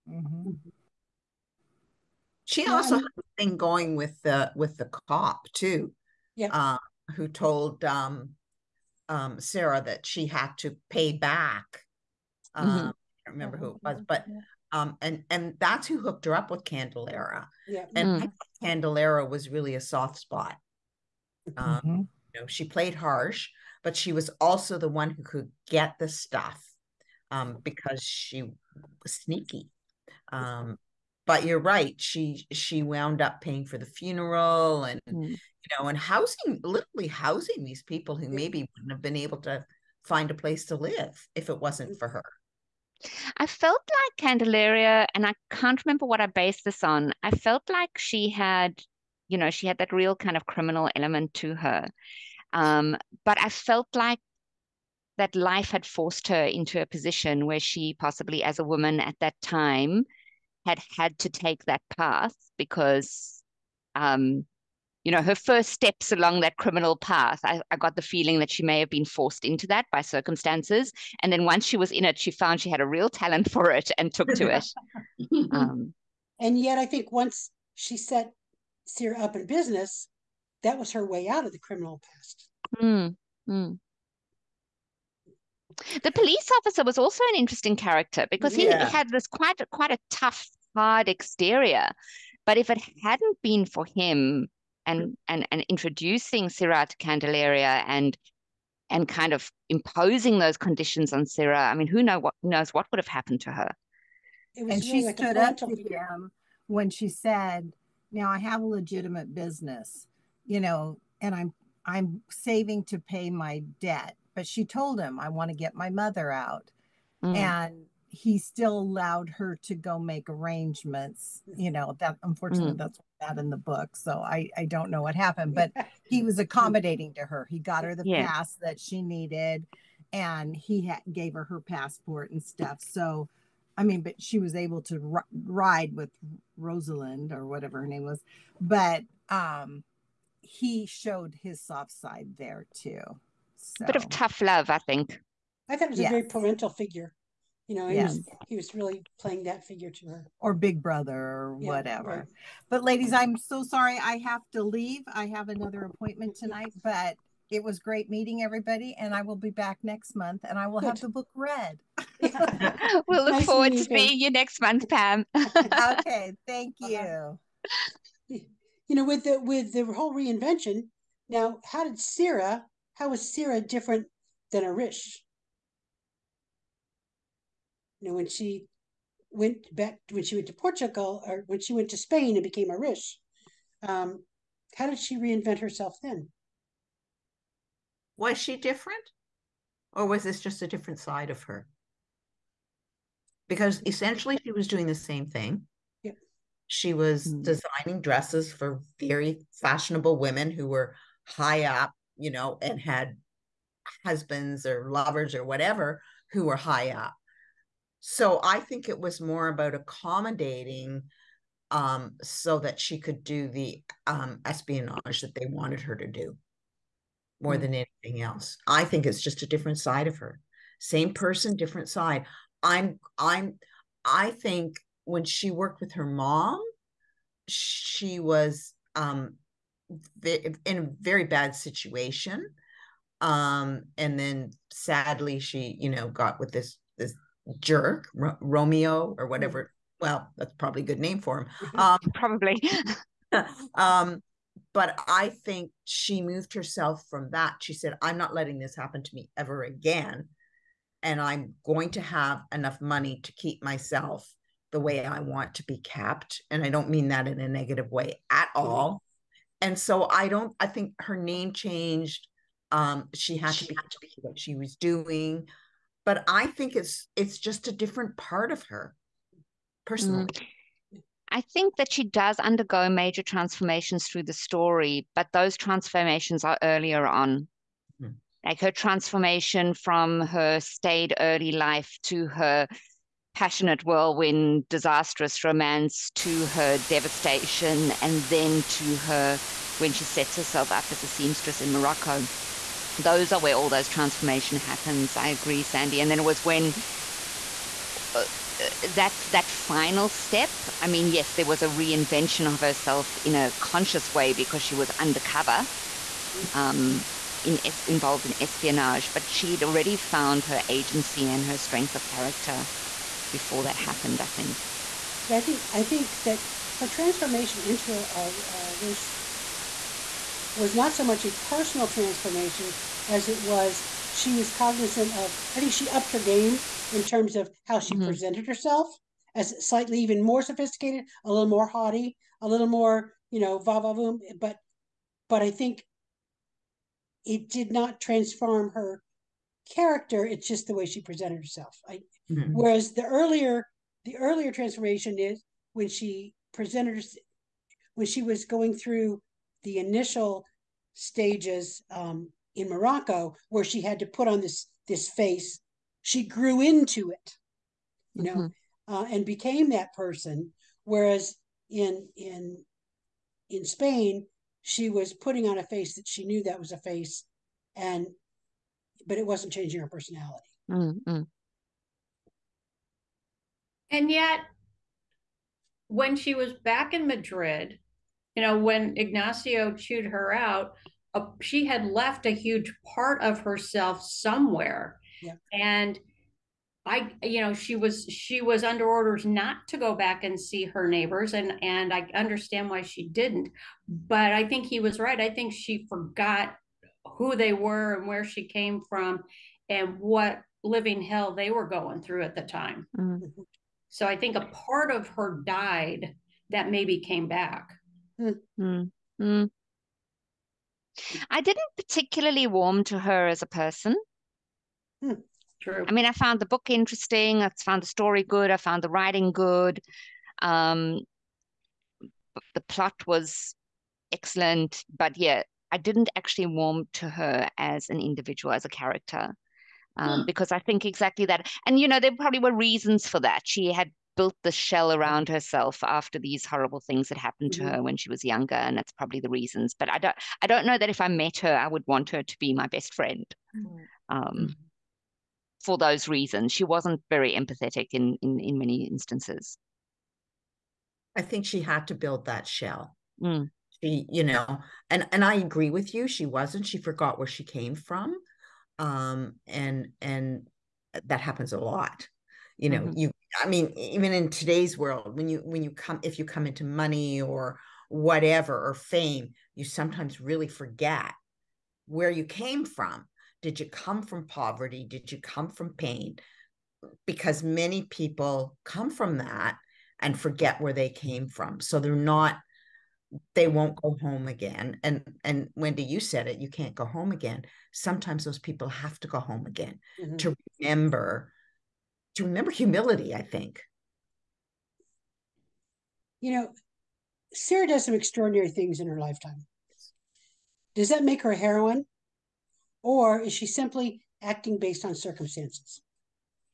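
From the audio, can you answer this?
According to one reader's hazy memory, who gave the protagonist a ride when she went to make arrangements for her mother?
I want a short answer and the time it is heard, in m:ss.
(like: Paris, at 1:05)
Rosalind, at 2:16.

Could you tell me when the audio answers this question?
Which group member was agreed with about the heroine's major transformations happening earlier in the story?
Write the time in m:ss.
4:55.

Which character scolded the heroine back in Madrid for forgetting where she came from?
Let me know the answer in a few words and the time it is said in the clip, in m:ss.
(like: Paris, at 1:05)
Ignacio, at 6:18.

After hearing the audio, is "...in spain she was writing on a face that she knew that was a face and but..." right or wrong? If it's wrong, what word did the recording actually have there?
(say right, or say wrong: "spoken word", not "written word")
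wrong: "putting", not "writing".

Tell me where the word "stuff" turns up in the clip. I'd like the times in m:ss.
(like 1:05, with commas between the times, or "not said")
0:26, 2:12.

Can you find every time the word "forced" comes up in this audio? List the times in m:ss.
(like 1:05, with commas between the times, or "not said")
0:55, 1:09.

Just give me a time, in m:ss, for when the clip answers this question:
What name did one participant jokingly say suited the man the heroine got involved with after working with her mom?
3:58.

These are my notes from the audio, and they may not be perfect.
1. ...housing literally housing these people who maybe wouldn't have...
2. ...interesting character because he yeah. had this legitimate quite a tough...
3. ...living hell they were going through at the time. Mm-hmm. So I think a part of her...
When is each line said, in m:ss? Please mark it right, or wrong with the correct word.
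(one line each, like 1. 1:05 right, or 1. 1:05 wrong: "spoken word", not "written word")
1. 0:35 right
2. 1:27 wrong: "quite", not "legitimate"
3. 6:40 right.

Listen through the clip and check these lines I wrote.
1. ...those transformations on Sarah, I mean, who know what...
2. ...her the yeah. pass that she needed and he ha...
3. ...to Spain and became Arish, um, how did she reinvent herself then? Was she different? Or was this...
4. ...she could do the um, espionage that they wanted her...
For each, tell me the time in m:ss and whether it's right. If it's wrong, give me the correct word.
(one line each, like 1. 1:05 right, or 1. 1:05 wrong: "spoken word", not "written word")
1. 1:40 wrong: "conditions", not "transformations"
2. 2:07 right
3. 3:01 right
4. 3:32 right.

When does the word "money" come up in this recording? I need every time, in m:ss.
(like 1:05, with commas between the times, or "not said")
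4:12, 7:46.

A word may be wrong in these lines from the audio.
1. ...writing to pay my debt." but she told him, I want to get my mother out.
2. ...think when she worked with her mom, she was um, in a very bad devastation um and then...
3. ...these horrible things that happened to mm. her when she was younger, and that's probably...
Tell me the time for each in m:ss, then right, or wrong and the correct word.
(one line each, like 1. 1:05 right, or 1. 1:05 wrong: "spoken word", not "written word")
1. 1:52 wrong: "saving", not "writing"
2. 3:44 wrong: "situation", not "devastation"
3. 7:16 right.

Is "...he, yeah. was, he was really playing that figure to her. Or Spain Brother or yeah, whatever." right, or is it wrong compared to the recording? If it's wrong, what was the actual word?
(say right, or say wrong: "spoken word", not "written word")
wrong: "Big", not "Spain".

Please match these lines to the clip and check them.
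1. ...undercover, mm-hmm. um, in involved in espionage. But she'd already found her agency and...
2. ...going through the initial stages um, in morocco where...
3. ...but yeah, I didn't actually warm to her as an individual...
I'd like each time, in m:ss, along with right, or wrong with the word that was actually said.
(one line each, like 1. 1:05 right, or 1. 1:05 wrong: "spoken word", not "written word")
1. 5:04 right
2. 5:48 right
3. 7:04 right.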